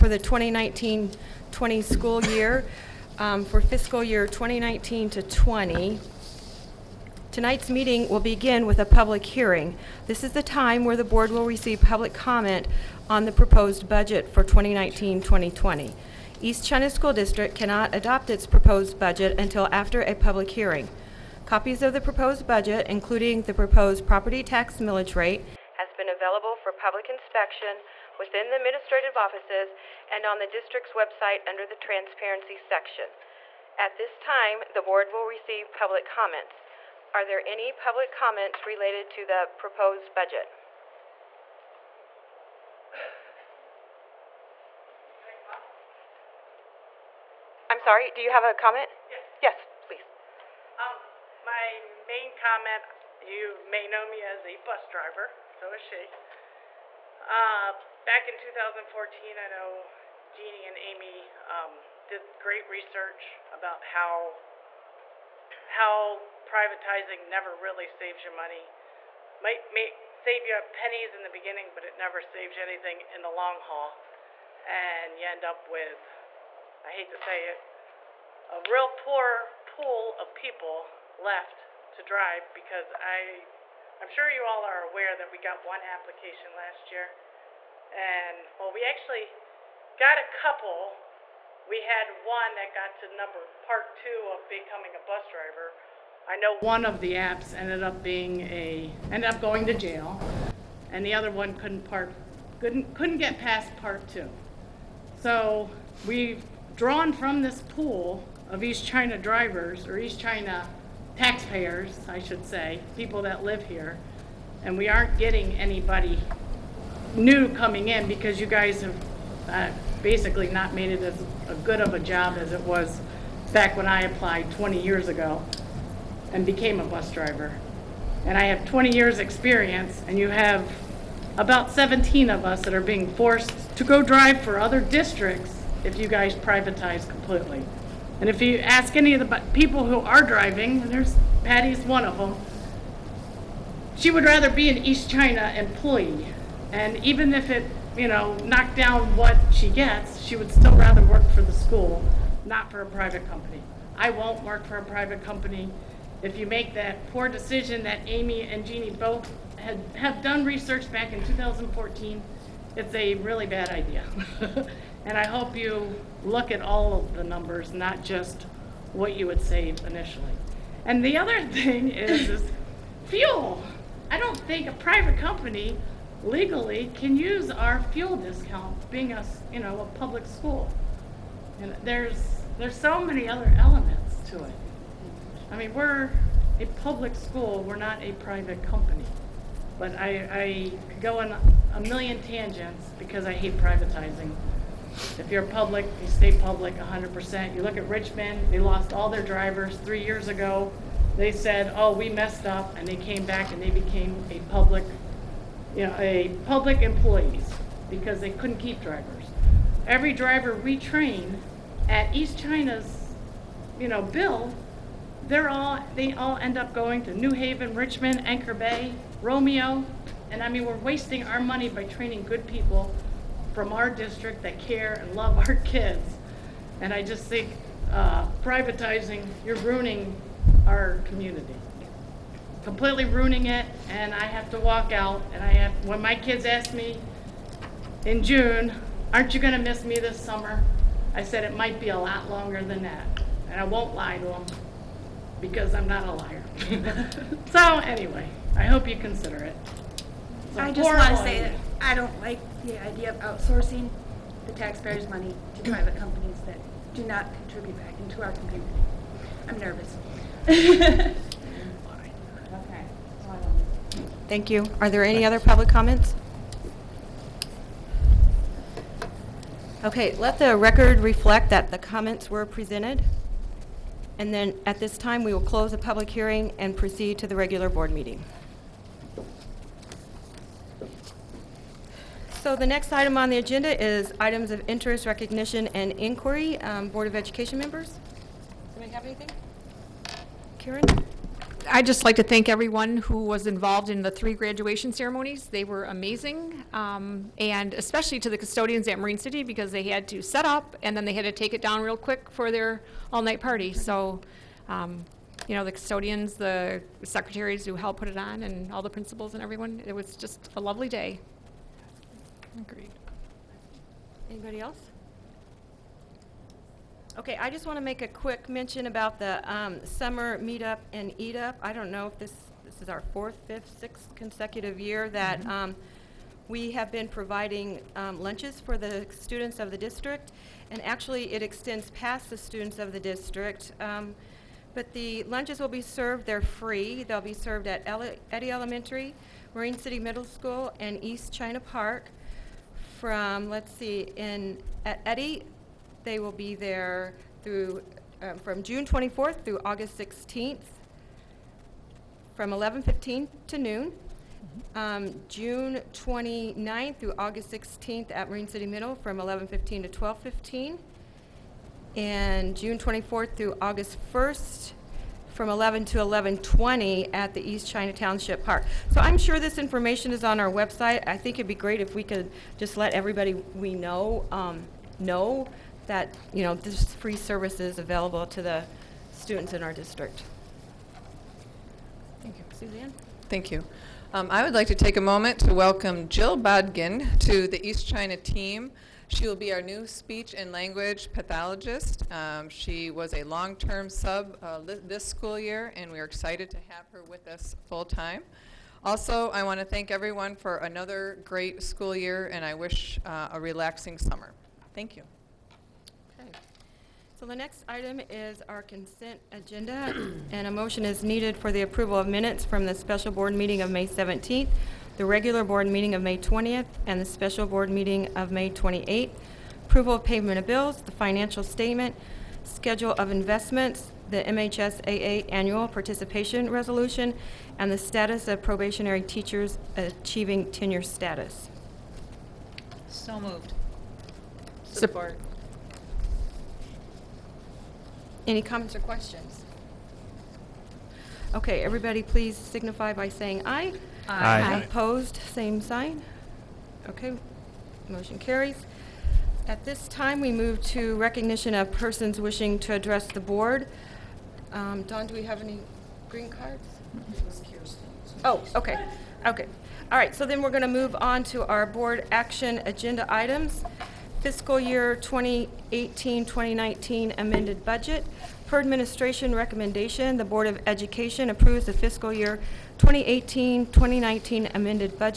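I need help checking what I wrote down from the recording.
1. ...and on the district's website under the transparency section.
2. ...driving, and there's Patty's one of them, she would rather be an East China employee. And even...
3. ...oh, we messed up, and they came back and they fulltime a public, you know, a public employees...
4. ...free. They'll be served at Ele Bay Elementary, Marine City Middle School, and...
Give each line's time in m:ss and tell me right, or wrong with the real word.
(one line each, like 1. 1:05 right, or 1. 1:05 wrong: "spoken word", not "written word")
1. 0:30 right
2. 2:20 right
3. 3:21 wrong: "became", not "fulltime"
4. 5:36 wrong: "Eddie", not "Bay".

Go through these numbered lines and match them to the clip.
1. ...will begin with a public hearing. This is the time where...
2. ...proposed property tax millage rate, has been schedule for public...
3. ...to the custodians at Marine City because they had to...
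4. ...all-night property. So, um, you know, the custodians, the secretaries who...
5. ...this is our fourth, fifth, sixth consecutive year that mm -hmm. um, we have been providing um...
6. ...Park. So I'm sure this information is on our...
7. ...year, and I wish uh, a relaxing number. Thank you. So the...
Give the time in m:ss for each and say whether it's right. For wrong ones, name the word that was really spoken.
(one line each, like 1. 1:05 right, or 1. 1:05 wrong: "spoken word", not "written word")
1. 0:08 right
2. 0:23 wrong: "available", not "schedule"
3. 4:58 right
4. 5:03 wrong: "party", not "property"
5. 5:22 right
6. 6:08 right
7. 6:41 wrong: "summer", not "number".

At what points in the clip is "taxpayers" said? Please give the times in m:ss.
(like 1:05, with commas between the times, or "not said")
1:51, 4:14.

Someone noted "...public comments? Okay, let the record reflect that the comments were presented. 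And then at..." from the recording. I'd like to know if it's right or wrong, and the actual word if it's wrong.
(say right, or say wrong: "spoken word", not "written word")
right.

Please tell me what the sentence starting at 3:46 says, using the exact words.
And I just think uh, privatizing, you're ruining our community, completely ruining it.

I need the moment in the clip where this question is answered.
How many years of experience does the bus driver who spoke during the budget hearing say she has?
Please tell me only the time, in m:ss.
2:08.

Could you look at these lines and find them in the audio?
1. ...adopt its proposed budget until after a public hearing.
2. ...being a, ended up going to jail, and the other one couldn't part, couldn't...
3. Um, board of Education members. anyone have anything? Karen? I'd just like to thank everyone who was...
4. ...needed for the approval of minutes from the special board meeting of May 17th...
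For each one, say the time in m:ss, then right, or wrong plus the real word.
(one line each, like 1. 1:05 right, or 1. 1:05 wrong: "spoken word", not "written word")
1. 0:17 right
2. 1:38 right
3. 4:46 right
4. 6:51 right.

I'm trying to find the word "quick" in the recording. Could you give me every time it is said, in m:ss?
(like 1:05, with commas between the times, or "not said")
5:01, 5:18.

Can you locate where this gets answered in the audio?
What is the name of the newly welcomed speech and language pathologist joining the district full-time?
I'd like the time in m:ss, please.
6:26.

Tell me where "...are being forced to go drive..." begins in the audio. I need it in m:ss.
2:12.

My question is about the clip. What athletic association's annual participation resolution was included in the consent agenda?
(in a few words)
MHSAA.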